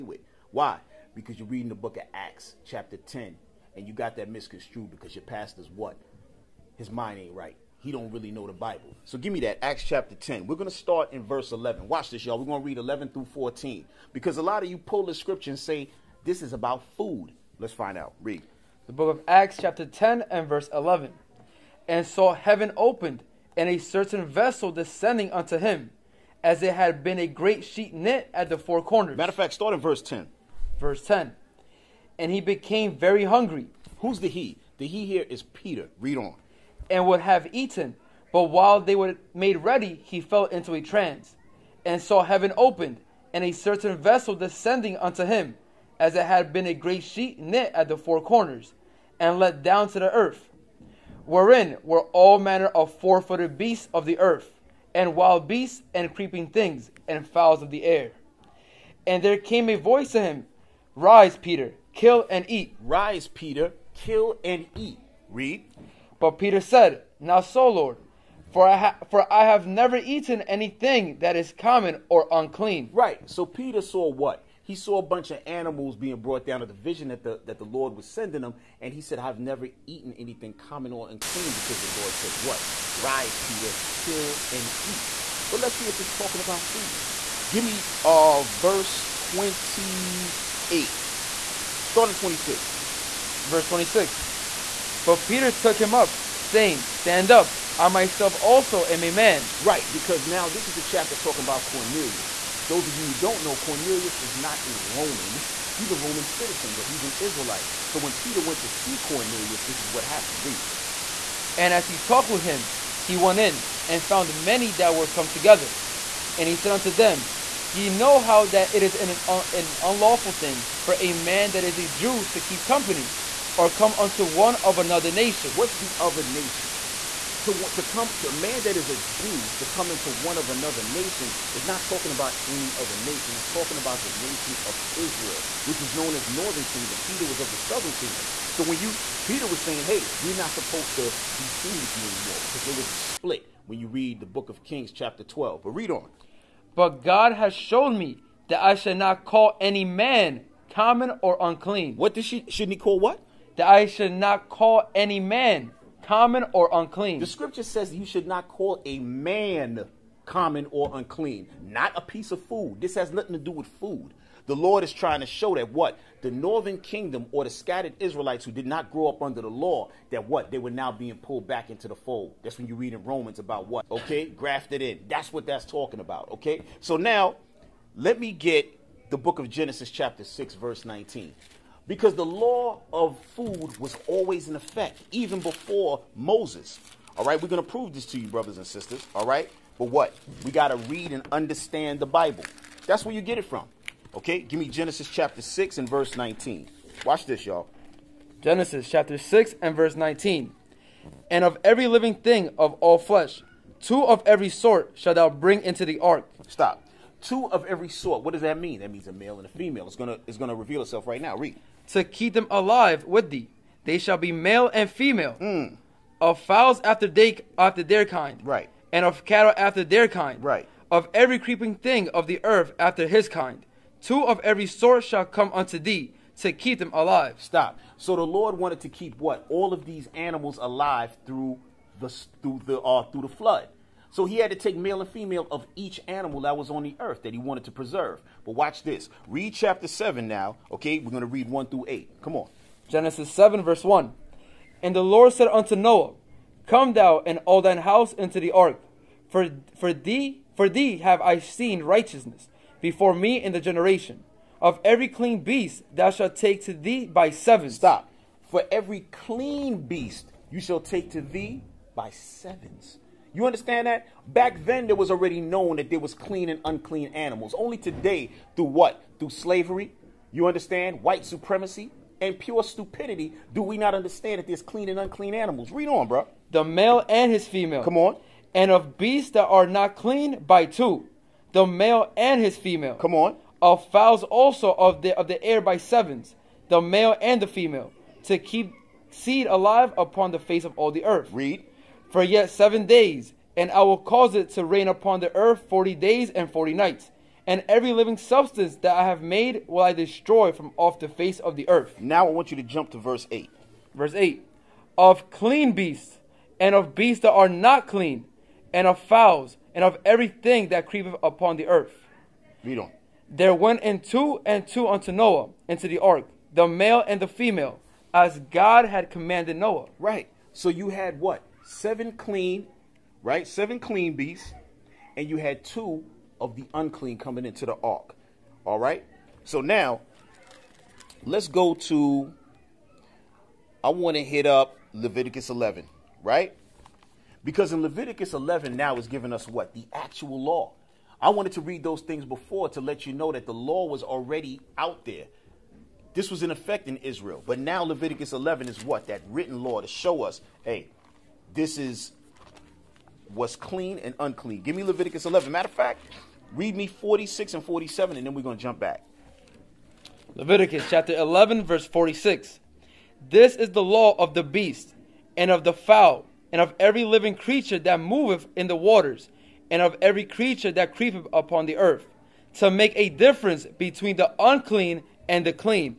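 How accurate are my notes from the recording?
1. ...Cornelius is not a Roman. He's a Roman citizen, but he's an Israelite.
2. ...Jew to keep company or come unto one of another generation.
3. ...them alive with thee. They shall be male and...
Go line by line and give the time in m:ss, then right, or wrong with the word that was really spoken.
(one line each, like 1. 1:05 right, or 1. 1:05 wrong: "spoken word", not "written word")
1. 1:43 right
2. 2:01 wrong: "nation", not "generation"
3. 3:32 right.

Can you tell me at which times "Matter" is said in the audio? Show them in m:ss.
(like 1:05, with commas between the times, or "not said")
0:29, 5:55.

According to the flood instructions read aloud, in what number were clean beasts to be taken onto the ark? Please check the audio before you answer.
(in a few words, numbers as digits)
7.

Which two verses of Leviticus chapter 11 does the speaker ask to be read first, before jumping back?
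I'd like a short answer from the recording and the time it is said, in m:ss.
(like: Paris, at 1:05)
46 and 47, at 5:56.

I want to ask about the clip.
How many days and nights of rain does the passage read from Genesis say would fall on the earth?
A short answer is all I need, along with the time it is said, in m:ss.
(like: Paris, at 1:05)
40, at 4:55.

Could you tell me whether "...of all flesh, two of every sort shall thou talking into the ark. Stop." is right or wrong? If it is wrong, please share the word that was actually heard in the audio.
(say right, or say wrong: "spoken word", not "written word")
wrong: "bring", not "talking".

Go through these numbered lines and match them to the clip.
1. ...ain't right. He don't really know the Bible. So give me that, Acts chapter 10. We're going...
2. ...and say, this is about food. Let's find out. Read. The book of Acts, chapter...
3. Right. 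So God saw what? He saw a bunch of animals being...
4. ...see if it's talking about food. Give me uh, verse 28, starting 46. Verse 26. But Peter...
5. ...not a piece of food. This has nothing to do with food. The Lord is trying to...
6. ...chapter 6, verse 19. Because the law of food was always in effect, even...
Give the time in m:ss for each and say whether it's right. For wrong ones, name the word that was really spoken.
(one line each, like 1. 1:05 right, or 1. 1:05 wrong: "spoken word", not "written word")
1. 0:07 right
2. 0:15 right
3. 1:12 wrong: "Peter", not "God"
4. 1:25 wrong: "26", not "46"
5. 2:41 right
6. 2:59 right.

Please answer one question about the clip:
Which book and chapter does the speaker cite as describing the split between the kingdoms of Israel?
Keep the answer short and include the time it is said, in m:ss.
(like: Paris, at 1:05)
Kings chapter 12, at 2:24.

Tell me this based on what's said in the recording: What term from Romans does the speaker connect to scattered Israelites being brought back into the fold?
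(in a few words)
Grafted in.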